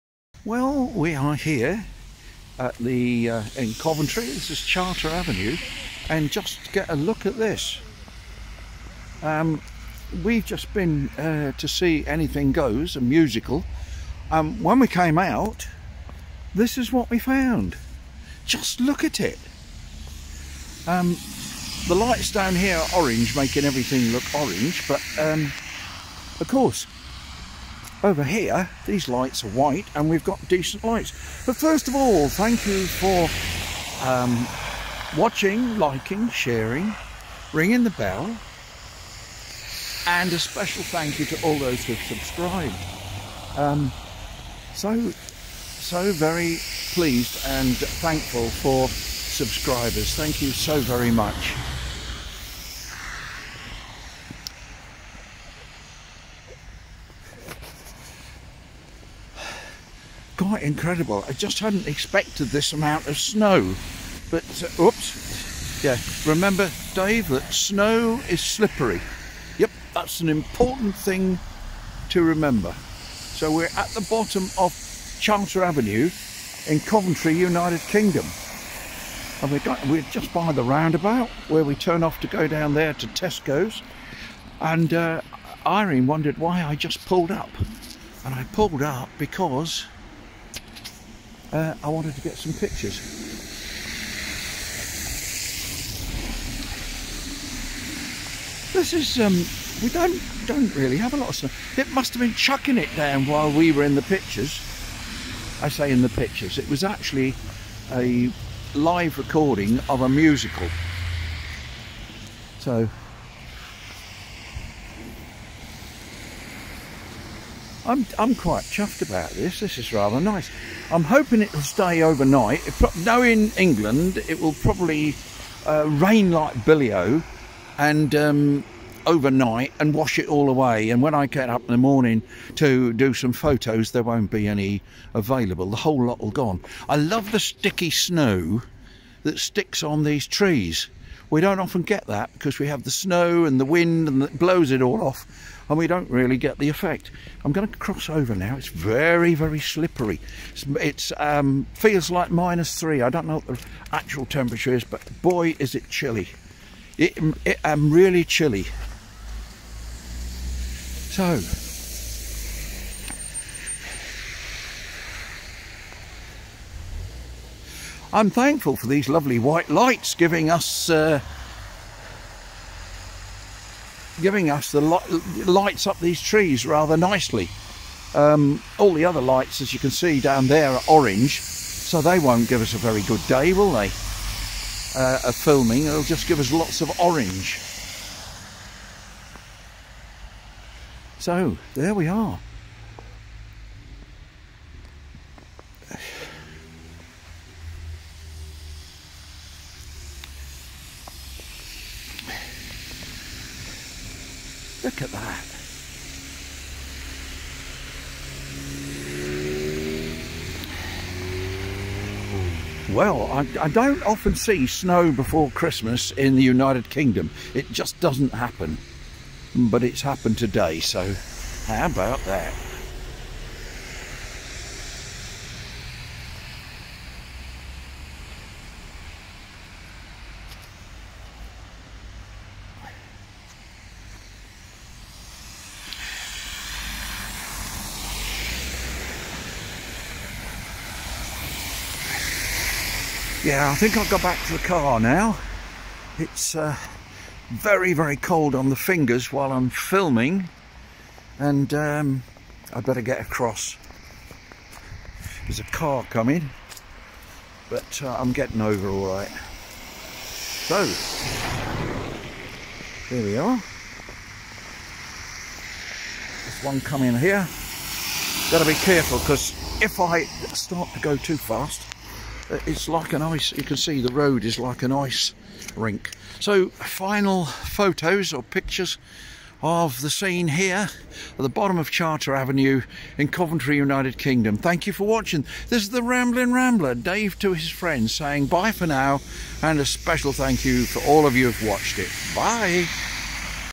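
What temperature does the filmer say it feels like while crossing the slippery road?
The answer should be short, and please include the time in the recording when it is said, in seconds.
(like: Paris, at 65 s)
-3, at 152 s.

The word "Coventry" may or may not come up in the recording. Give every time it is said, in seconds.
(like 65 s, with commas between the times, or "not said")
3 s, 76 s, 283 s.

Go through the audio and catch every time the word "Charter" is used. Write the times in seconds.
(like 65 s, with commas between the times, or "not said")
4 s, 75 s, 281 s.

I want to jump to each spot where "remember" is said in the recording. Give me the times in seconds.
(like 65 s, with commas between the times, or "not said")
66 s, 72 s.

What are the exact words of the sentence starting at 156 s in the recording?
It, it, I'm um, really chilly.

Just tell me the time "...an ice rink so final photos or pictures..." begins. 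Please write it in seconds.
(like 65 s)
274 s.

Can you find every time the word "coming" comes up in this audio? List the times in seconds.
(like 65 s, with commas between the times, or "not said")
256 s, 266 s.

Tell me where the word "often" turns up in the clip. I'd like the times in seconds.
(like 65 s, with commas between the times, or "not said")
141 s, 214 s.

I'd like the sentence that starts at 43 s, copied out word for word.
Um, so, so very pleased and thankful for subscribers.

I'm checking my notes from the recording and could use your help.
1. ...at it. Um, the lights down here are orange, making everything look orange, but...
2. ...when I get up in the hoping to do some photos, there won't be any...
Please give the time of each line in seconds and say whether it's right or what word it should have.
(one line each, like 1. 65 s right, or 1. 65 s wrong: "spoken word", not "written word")
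1. 19 s right
2. 131 s wrong: "morning", not "hoping".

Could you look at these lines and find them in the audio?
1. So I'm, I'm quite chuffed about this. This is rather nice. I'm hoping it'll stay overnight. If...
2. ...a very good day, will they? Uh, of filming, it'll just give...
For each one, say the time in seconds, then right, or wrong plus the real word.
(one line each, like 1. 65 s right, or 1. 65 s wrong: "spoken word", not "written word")
1. 112 s right
2. 182 s right.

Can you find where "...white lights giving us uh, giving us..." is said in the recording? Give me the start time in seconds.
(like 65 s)
169 s.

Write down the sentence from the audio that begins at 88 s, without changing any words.
And I pulled up because uh, I wanted to get some pictures.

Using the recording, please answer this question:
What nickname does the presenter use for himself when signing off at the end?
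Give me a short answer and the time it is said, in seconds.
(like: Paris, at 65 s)
The Rambling Rambler, at 285 s.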